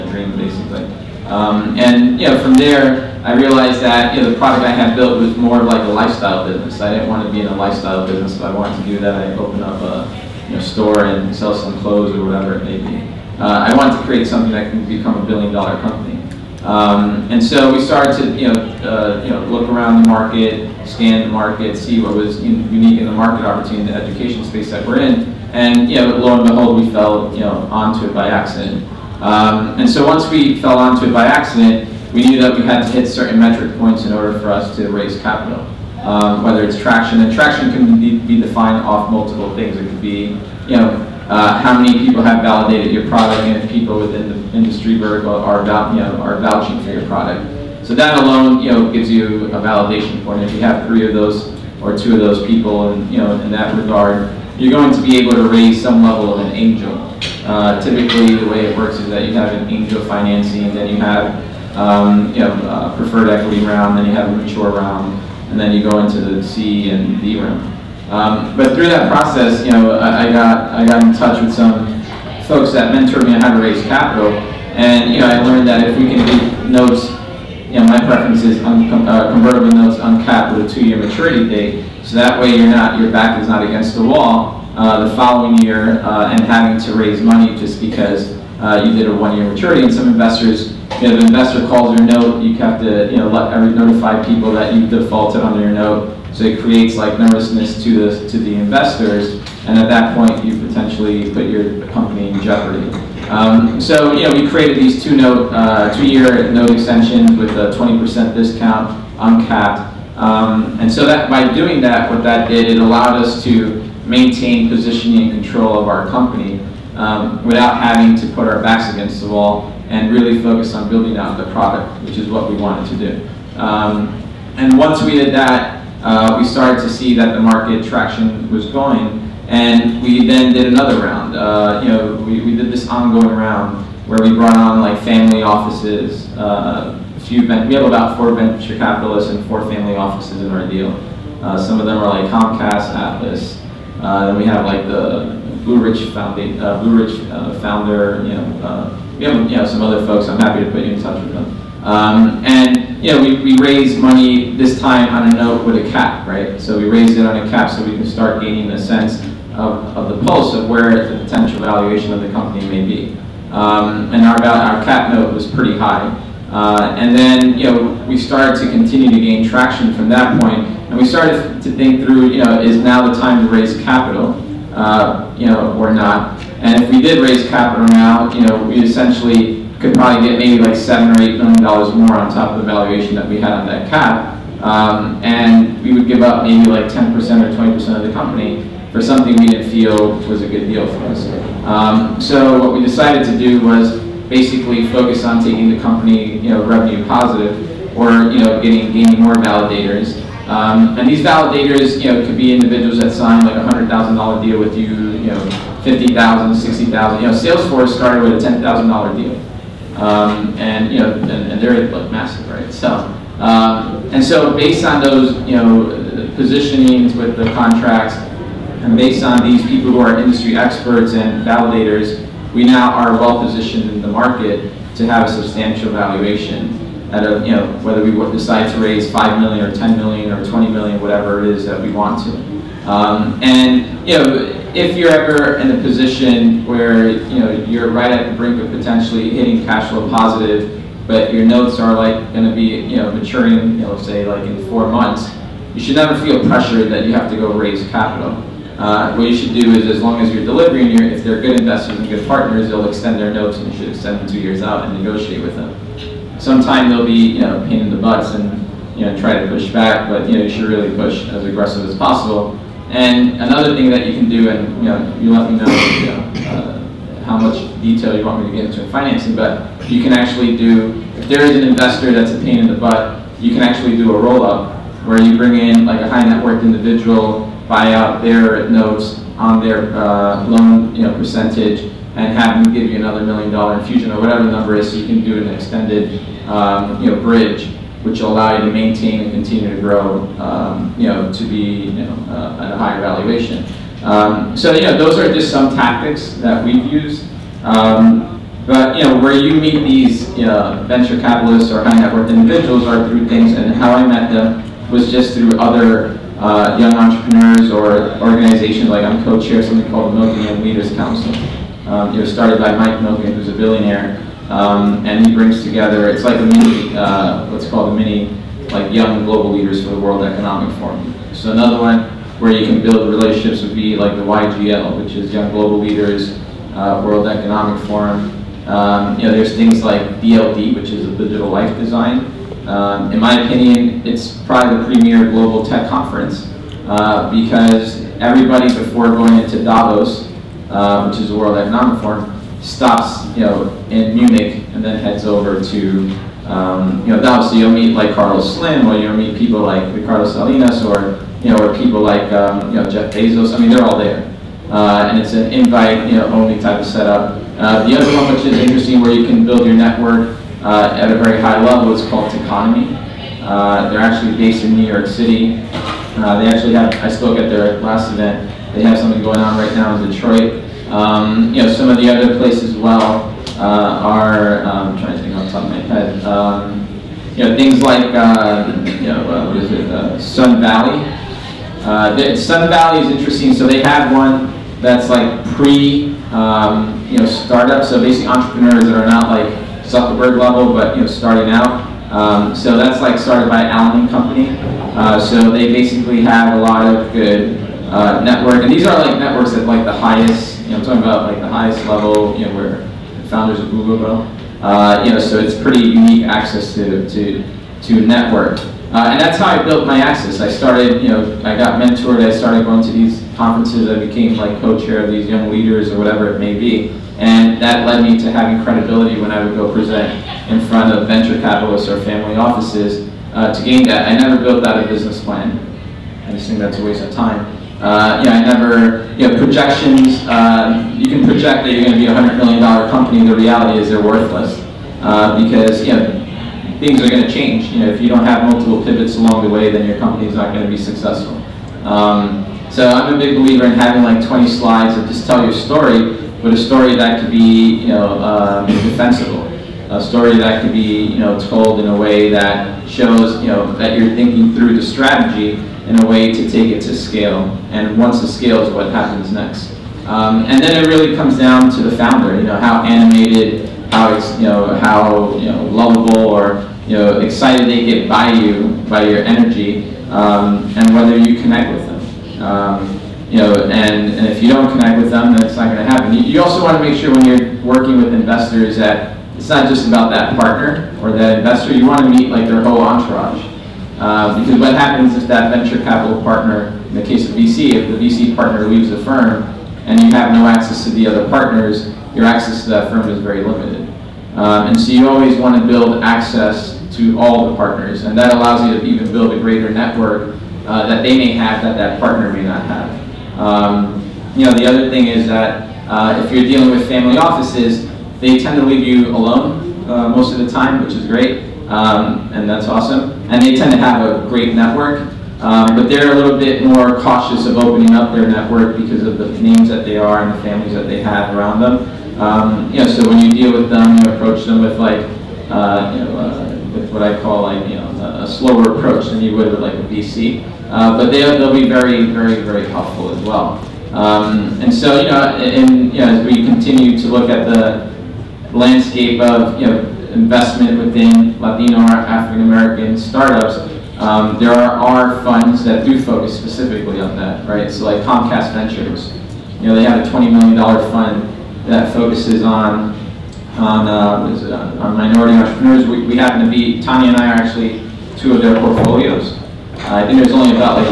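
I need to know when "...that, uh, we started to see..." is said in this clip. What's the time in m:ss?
2:05.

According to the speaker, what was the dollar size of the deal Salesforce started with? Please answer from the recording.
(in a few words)
$10,000.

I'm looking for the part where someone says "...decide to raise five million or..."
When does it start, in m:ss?
3:48.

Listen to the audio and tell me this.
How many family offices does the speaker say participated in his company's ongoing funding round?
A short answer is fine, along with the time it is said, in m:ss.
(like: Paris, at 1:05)
4, at 2:19.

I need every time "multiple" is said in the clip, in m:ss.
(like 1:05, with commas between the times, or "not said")
0:39, 7:18.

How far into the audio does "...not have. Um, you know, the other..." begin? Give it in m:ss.
8:22.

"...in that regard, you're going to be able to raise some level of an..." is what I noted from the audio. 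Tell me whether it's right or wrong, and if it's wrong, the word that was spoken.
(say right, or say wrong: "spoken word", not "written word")
right.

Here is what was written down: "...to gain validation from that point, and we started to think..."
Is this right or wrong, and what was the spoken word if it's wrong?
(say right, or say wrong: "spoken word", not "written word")
wrong: "traction", not "validation".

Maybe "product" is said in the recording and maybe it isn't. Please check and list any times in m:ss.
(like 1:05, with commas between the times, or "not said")
0:04, 0:43, 0:47, 2:01.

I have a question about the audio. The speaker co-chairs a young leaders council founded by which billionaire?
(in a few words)
Mike Milken.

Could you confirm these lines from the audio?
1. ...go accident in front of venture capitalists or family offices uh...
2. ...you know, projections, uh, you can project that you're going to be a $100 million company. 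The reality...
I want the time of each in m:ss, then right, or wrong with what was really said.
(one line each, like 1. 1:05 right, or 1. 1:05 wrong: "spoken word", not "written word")
1. 6:59 wrong: "present", not "accident"
2. 7:09 right.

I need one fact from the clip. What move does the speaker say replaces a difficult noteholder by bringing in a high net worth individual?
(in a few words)
roll-up.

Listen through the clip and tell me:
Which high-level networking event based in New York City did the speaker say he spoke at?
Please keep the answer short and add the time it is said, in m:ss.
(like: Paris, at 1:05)
Techonomy, at 6:02.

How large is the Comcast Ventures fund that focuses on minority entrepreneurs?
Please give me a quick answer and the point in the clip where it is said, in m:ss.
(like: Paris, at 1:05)
$20 million, at 9:10.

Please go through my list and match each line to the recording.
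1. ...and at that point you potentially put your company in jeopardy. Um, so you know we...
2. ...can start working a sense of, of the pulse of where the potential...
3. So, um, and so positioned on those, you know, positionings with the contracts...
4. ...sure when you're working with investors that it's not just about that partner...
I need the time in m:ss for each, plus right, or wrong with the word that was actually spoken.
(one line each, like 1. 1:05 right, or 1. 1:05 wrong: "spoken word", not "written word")
1. 1:39 right
2. 2:37 wrong: "gaining", not "working"
3. 3:32 wrong: "based", not "positioned"
4. 7:56 right.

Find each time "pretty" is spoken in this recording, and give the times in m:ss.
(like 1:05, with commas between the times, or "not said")
2:45, 6:45.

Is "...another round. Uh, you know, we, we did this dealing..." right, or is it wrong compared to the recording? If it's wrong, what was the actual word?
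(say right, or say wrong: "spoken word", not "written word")
wrong: "ongoing", not "dealing".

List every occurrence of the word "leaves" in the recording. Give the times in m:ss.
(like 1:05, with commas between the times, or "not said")
8:08, 8:28.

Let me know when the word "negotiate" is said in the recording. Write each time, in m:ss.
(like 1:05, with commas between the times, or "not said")
4:15.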